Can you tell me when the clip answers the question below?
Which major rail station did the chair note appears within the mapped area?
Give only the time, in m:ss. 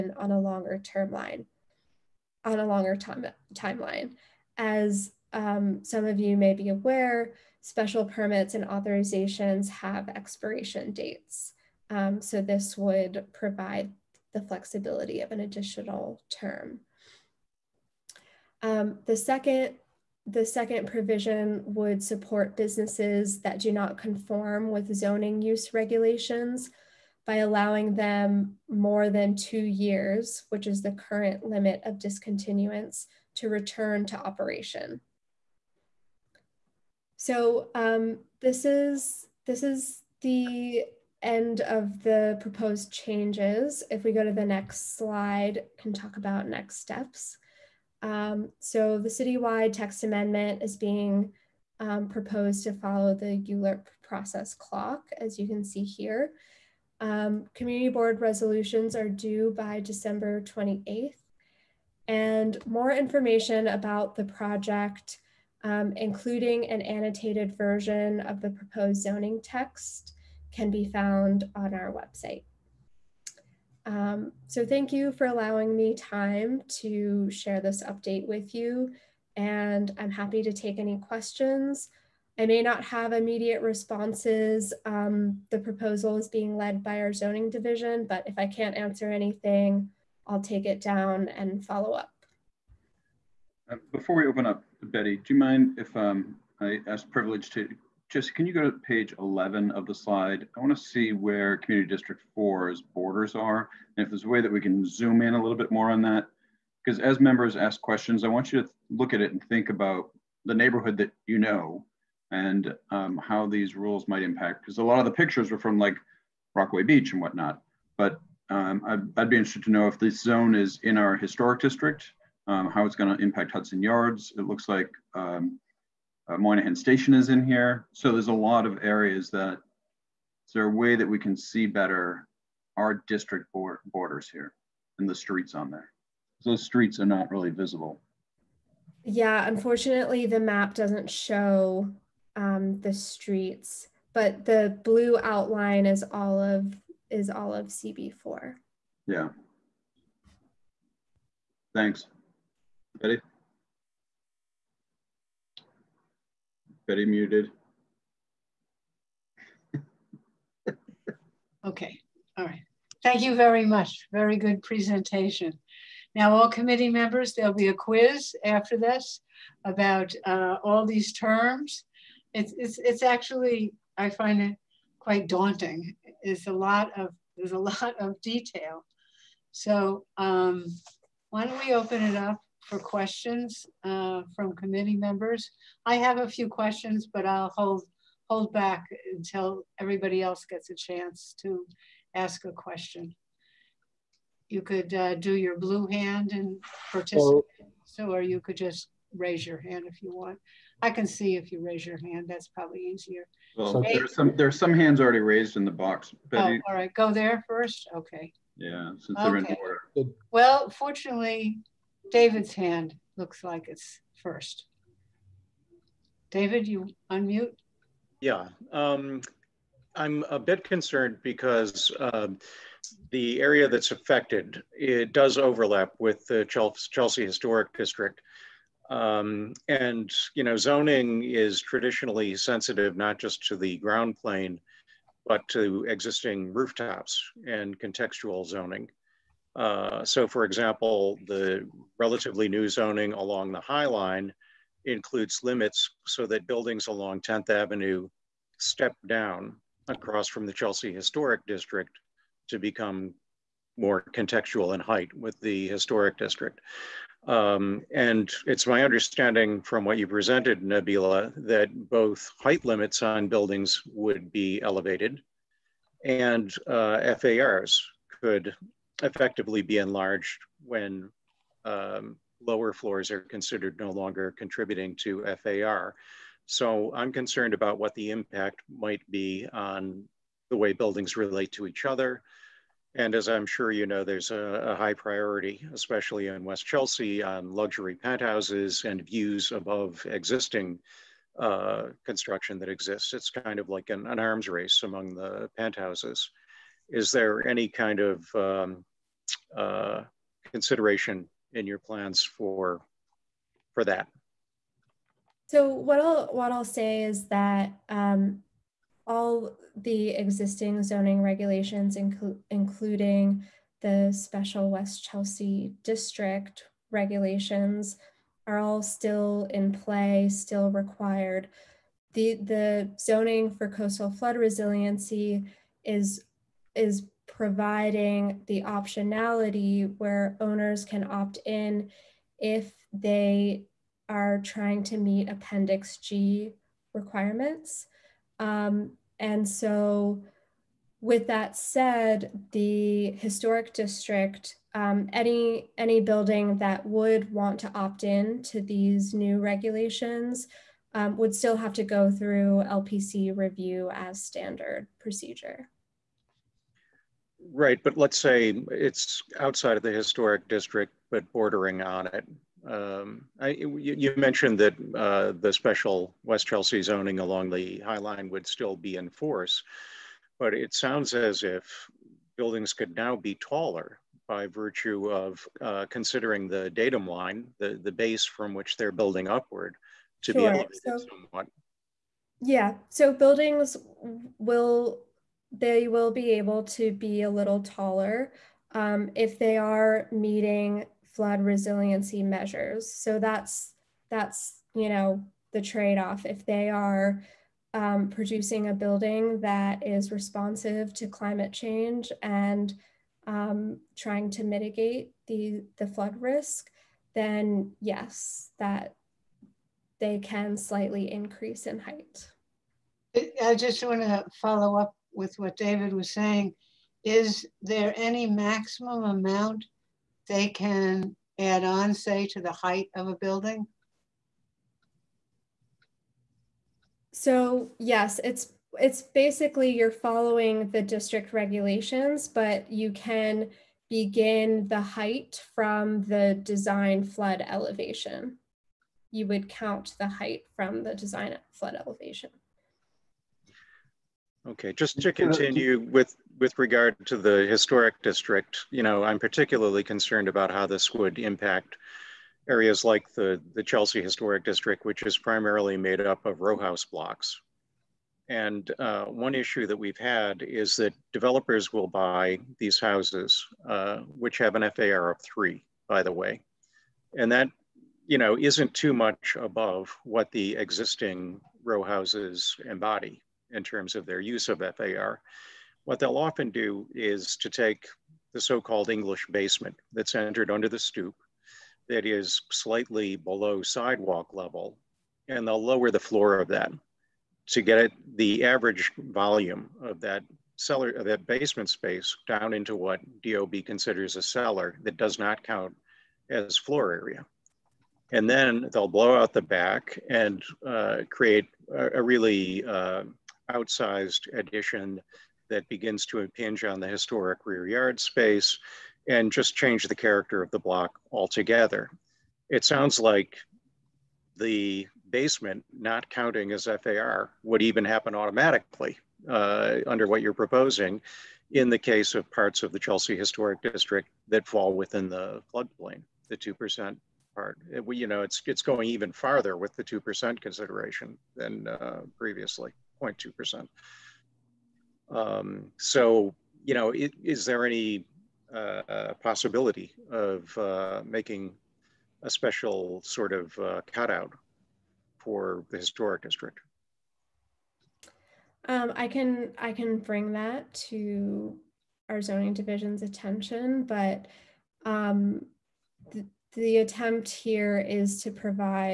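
2:06.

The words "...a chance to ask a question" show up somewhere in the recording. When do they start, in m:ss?
3:10.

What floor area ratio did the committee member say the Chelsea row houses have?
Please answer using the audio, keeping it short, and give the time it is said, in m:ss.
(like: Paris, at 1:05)
3, at 7:45.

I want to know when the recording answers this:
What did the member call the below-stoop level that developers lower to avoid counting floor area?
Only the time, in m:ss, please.
7:58.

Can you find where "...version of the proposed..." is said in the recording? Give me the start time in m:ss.
1:07.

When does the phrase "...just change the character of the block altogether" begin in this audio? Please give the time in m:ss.
8:29.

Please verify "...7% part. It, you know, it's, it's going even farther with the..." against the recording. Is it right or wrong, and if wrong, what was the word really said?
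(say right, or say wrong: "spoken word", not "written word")
wrong: "2", not "7".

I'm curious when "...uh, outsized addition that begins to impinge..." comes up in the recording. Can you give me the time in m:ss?
8:22.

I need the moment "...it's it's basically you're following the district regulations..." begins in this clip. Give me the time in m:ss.
7:08.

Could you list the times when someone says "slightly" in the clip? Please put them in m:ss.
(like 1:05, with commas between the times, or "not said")
6:50, 8:02.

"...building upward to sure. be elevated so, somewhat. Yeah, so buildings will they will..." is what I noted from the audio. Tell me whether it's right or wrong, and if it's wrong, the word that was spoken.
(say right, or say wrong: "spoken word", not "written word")
right.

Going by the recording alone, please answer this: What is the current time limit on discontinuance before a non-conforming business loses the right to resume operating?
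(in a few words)
2 years.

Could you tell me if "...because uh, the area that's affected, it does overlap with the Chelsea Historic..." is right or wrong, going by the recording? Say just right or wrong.
right.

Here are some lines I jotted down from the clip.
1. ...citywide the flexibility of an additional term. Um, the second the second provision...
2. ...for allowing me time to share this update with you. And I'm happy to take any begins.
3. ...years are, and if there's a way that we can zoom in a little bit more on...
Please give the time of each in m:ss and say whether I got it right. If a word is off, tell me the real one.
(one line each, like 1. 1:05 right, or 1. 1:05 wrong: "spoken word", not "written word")
1. 0:13 wrong: "provide", not "citywide"
2. 1:15 wrong: "questions", not "begins"
3. 1:42 wrong: "borders", not "years".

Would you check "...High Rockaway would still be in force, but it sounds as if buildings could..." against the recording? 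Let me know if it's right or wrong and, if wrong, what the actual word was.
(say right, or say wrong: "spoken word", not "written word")
wrong: "Line", not "Rockaway".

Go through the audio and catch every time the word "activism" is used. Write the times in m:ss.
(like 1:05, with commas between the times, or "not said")
not said.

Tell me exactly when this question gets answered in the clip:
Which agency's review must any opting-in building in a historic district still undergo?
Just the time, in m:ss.
5:52.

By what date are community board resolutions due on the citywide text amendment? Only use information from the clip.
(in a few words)
December 28th.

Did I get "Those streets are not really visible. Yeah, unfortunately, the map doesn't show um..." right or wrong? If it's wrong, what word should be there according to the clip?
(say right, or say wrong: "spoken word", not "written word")
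right.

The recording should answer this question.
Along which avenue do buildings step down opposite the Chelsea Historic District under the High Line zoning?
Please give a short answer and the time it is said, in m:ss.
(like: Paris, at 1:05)
10th Avenue, at 4:07.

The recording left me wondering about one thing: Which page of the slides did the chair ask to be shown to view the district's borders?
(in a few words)
Page 11.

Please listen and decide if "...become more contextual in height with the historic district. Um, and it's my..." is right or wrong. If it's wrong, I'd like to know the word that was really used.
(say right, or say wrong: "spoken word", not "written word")
right.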